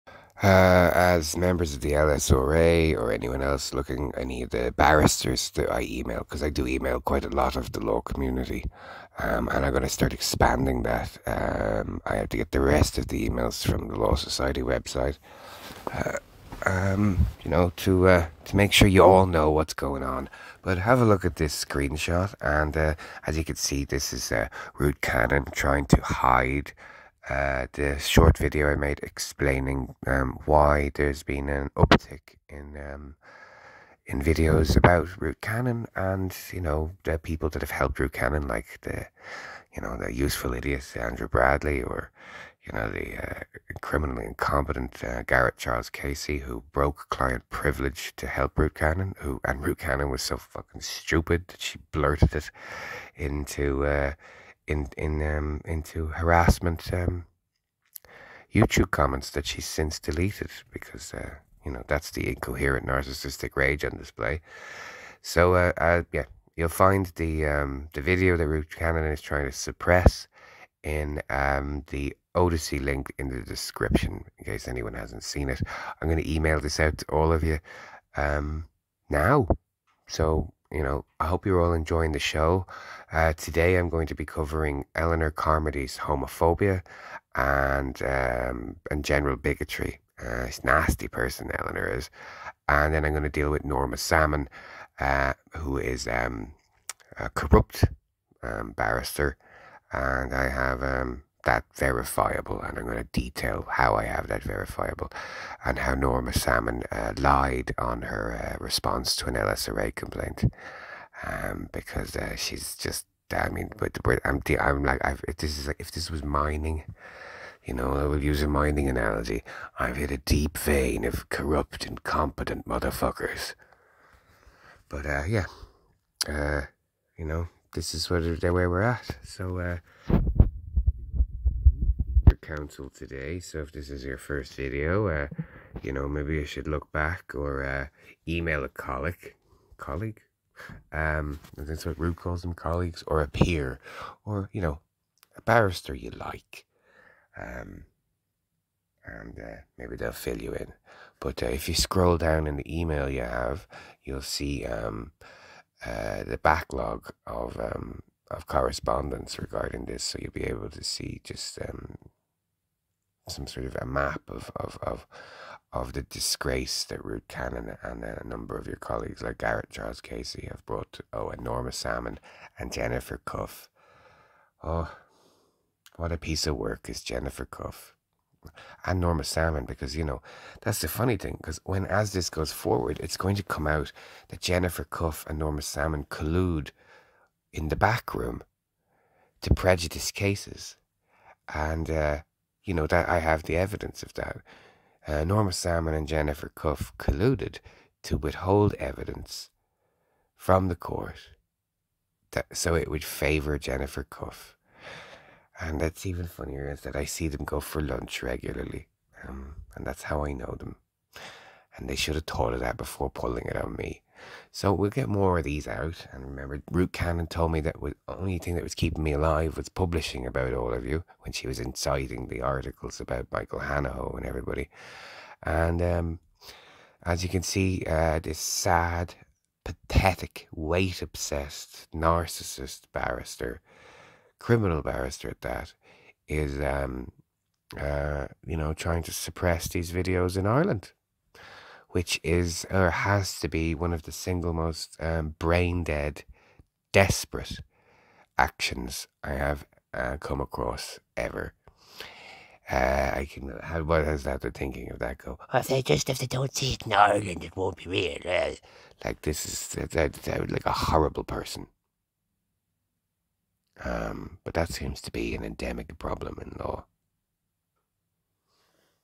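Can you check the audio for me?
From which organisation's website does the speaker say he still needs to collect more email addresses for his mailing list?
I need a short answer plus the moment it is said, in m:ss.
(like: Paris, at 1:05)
Law Society, at 0:13.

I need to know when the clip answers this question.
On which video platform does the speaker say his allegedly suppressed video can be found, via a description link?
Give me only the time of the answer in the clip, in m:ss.
1:12.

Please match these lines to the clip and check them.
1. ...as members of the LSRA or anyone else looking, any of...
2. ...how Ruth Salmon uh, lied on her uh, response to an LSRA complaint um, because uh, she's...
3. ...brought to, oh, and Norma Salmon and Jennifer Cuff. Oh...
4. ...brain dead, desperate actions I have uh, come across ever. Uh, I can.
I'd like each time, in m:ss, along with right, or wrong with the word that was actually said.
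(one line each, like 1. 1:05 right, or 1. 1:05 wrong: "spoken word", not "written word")
1. 0:00 right
2. 1:45 wrong: "Norma", not "Ruth"
3. 2:50 right
4. 4:05 right.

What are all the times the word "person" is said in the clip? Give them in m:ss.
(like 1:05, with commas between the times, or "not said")
1:31, 4:21.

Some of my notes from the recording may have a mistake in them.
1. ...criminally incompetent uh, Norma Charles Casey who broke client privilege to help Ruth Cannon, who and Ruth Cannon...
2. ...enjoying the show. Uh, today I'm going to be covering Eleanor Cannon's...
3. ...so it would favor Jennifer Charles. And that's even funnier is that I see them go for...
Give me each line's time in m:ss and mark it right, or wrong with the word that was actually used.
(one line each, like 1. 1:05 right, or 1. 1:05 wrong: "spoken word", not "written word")
1. 0:43 wrong: "Garrett", not "Norma"
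2. 1:21 wrong: "Carmody", not "Cannon"
3. 3:22 wrong: "Cuff", not "Charles".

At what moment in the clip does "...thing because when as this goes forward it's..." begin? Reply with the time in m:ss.
3:01.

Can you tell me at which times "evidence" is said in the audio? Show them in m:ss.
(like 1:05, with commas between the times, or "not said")
3:13, 3:18.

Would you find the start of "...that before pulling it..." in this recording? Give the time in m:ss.
3:32.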